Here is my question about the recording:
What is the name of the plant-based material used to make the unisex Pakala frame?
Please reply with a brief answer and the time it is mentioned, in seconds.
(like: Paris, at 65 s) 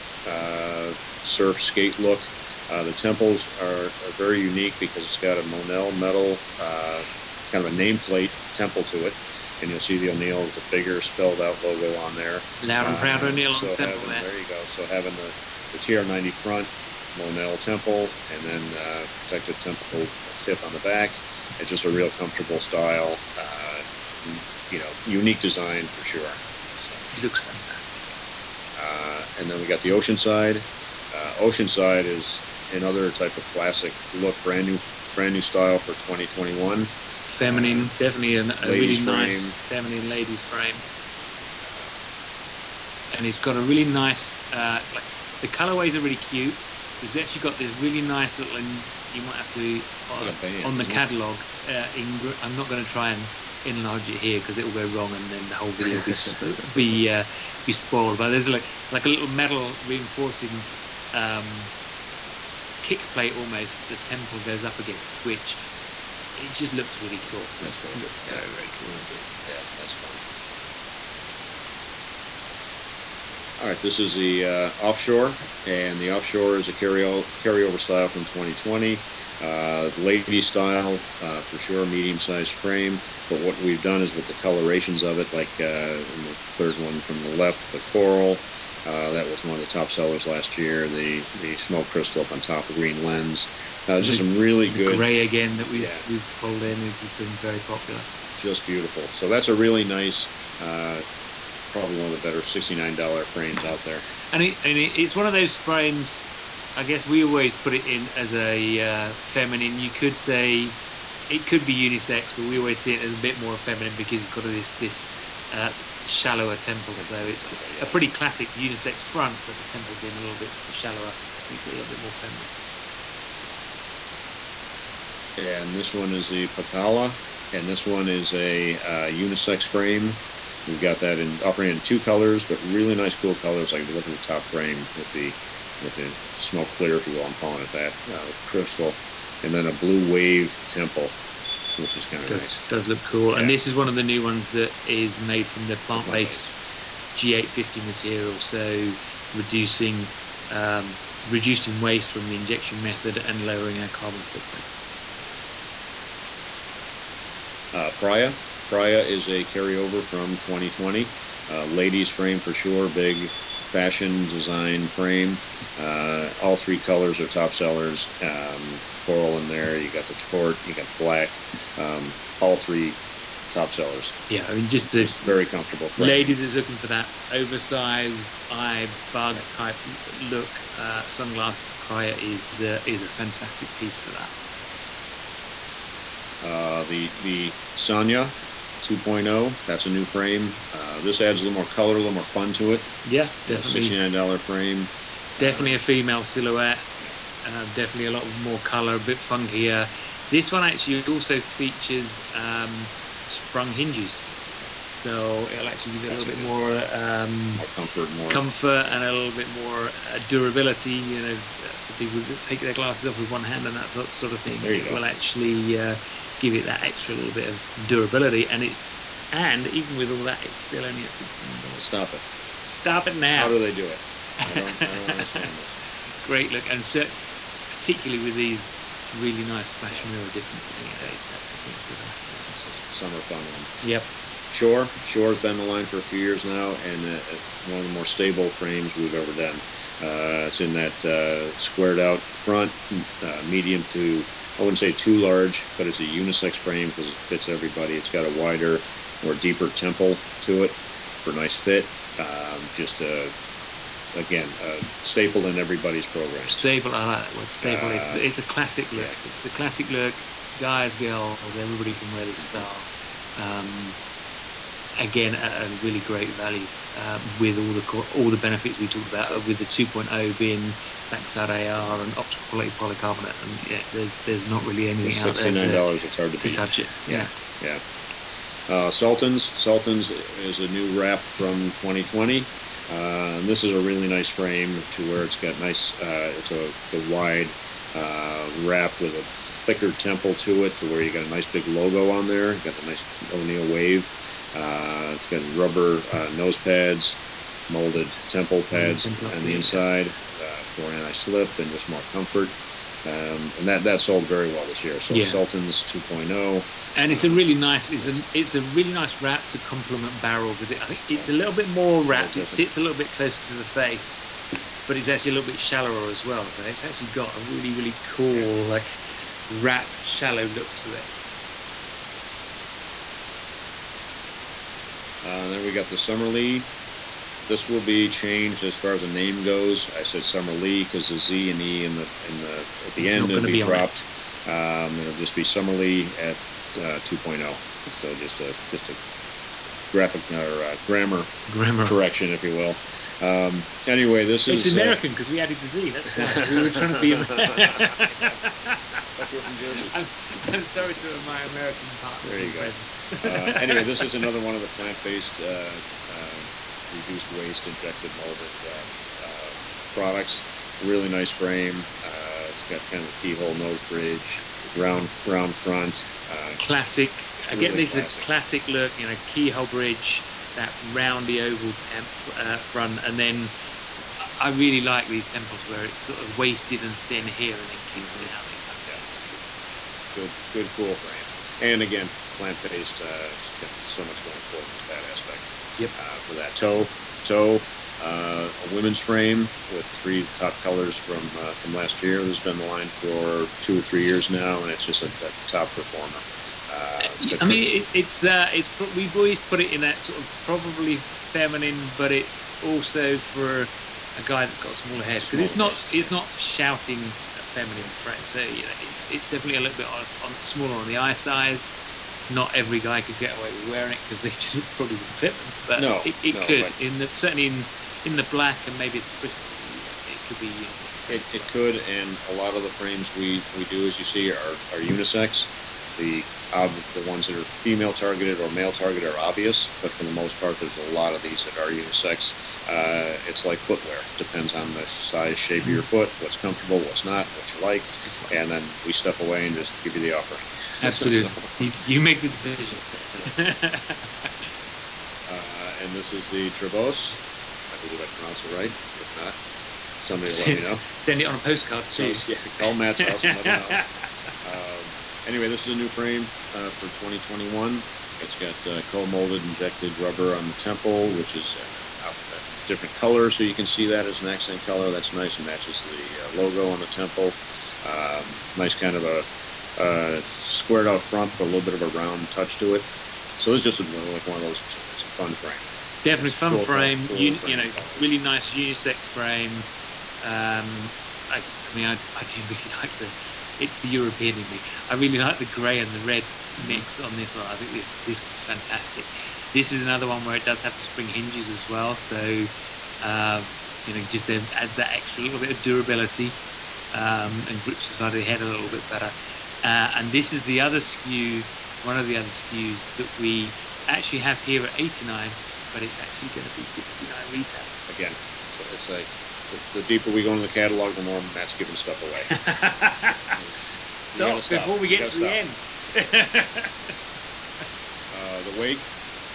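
G850, at 147 s.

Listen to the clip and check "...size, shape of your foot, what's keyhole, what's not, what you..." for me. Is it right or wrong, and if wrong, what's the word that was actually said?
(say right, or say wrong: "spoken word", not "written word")
wrong: "comfortable", not "keyhole".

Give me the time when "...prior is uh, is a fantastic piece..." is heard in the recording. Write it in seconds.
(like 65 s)
181 s.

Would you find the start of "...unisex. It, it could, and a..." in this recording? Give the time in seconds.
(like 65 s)
420 s.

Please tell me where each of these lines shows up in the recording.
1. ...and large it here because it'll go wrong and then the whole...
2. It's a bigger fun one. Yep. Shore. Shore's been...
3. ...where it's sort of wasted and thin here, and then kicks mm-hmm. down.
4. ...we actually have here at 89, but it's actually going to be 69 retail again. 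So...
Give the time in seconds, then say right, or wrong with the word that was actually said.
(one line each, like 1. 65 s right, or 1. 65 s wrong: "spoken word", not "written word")
1. 53 s wrong: "enlarge", not "large"
2. 232 s wrong: "summer", not "bigger"
3. 375 s right
4. 503 s right.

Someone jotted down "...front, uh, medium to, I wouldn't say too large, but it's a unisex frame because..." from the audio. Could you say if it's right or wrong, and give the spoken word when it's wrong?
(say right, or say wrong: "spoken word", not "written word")
right.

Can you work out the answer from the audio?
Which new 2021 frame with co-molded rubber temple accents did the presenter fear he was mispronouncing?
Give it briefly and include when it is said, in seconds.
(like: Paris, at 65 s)
Trevose, at 446 s.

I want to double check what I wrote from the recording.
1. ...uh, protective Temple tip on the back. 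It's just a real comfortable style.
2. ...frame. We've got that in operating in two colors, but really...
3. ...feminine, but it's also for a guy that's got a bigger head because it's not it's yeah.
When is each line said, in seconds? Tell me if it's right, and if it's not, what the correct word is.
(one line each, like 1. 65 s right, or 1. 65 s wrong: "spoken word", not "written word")
1. 18 s right
2. 129 s right
3. 401 s wrong: "smaller", not "bigger".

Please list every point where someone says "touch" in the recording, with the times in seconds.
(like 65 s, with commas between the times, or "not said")
276 s, 472 s.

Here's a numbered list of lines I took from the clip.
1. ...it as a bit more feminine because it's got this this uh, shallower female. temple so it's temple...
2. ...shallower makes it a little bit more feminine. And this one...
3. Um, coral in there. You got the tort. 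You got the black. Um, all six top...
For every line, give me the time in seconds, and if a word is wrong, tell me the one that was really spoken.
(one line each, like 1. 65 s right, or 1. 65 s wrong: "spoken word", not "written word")
1. 112 s wrong: "temple", not "female"
2. 120 s right
3. 168 s wrong: "three", not "six".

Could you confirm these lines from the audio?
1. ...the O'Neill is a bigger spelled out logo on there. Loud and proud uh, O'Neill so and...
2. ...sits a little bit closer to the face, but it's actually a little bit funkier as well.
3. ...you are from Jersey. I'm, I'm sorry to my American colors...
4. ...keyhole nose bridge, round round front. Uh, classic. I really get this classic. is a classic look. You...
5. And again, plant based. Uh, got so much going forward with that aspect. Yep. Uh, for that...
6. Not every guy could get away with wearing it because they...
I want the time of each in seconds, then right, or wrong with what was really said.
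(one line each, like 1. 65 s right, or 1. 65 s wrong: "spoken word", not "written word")
1. 9 s right
2. 312 s wrong: "shallower", not "funkier"
3. 349 s wrong: "partners", not "colors"
4. 363 s right
5. 381 s right
6. 412 s right.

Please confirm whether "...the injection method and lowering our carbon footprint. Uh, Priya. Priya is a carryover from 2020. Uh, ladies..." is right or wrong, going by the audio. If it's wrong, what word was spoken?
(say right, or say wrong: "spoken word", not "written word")
right.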